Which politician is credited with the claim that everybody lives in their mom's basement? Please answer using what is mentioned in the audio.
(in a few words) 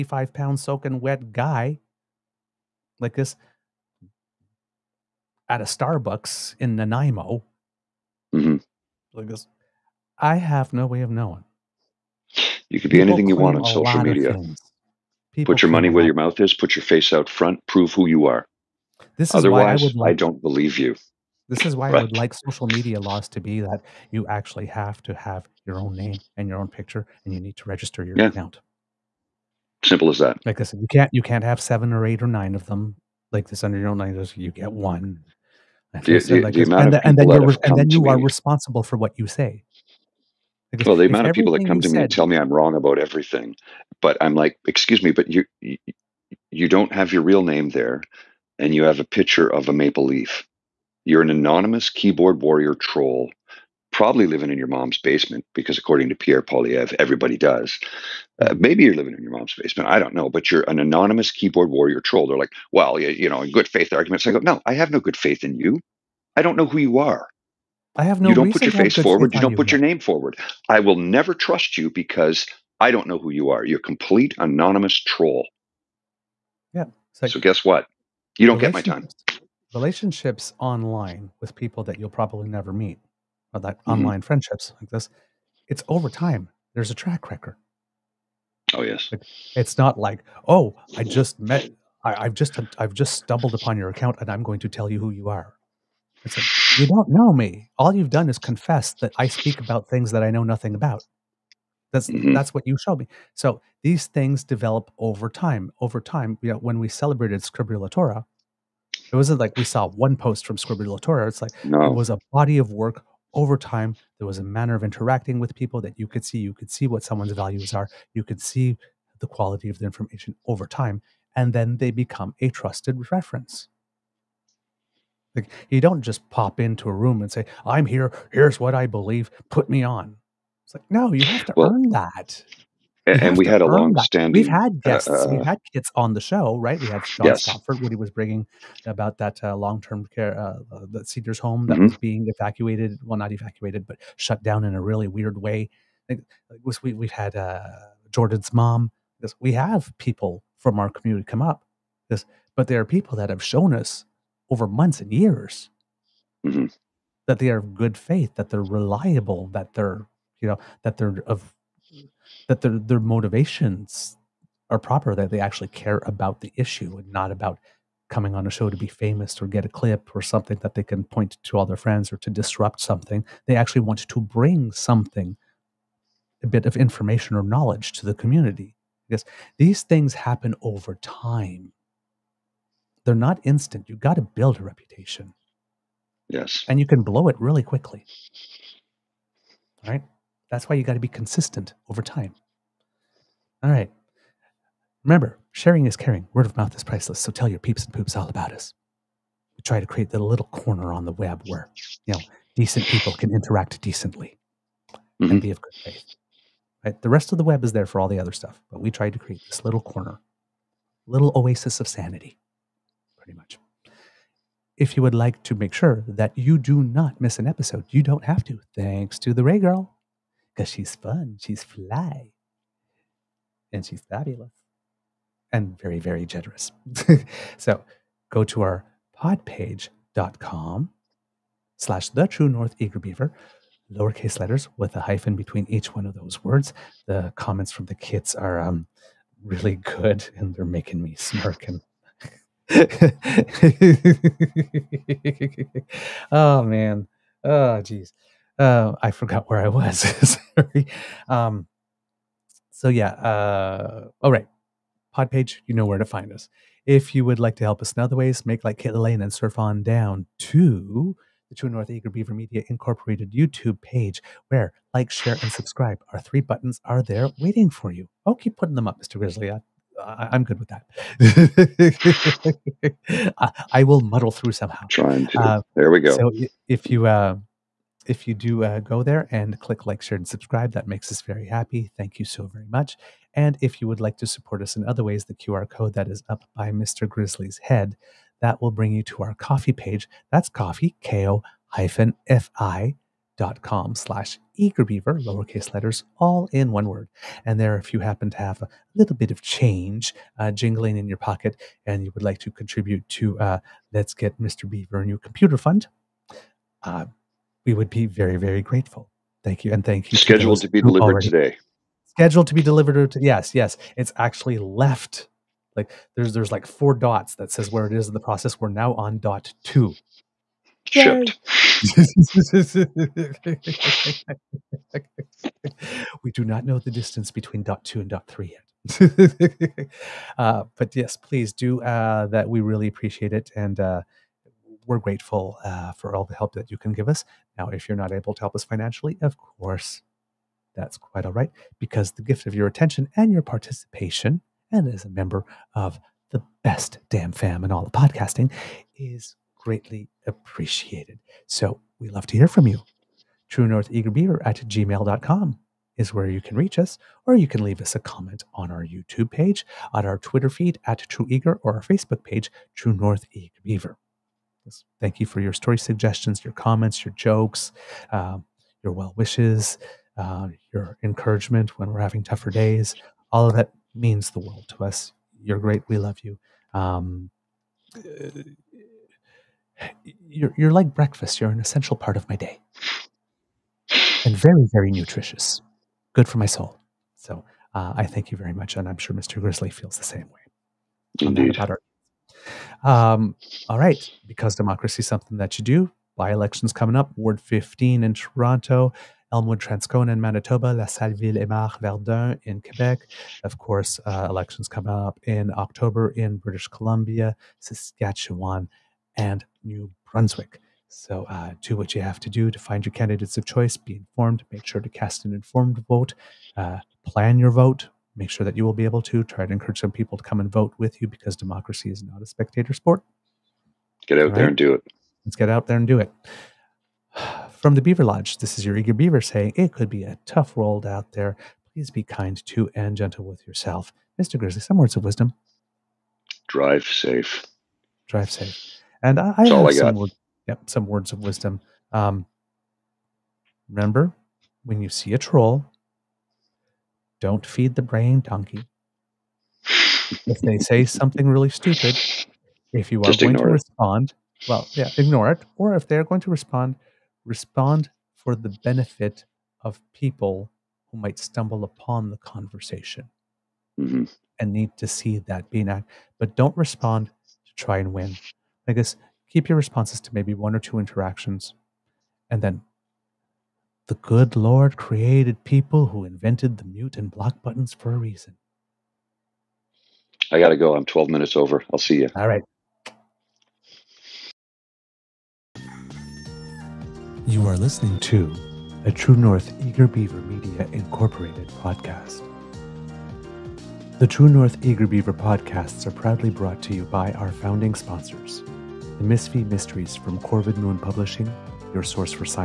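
Pierre Poilievre.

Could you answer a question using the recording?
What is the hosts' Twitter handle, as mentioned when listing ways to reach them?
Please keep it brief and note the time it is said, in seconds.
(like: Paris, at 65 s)
True Eager, at 361 s.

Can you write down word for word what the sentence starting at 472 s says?
And then the good Lord created people who invented the mute and block buttons for a reason.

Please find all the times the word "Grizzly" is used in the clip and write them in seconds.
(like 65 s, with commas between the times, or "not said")
269 s, 287 s, 389 s, 434 s.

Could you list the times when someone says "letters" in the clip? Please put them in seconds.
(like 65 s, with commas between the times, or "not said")
234 s, 295 s.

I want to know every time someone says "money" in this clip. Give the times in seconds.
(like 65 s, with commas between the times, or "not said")
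15 s.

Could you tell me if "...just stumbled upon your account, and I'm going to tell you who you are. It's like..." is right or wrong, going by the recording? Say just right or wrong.
right.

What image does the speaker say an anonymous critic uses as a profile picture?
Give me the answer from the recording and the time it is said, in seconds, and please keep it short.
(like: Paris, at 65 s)
A maple leaf, at 49 s.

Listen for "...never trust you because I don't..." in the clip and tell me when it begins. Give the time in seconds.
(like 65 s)
70 s.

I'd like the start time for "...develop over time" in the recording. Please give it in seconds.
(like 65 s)
104 s.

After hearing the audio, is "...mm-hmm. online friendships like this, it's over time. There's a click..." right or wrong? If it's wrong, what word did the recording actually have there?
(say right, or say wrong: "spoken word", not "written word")
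wrong: "track", not "click".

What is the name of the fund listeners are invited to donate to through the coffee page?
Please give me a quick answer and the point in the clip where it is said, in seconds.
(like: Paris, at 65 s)
Let's Get Mr. Beaver a New Computer Fund, at 303 s.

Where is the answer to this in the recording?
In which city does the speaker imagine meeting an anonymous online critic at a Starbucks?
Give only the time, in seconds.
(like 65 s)
6 s.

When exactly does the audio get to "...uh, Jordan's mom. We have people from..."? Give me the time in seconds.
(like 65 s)
147 s.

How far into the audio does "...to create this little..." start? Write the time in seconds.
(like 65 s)
209 s.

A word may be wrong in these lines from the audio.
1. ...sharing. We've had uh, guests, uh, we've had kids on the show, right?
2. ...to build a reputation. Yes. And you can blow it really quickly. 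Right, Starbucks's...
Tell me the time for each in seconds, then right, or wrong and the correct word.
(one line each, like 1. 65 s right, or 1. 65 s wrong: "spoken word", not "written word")
1. 133 s wrong: "standing", not "sharing"
2. 184 s wrong: "That", not "Starbucks".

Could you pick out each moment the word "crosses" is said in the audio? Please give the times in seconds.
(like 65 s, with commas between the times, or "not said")
not said.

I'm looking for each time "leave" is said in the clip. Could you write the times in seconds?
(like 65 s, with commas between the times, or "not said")
357 s.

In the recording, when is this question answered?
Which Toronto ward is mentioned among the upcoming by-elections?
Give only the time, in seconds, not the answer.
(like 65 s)
397 s.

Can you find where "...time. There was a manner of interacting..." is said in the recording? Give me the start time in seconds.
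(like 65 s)
113 s.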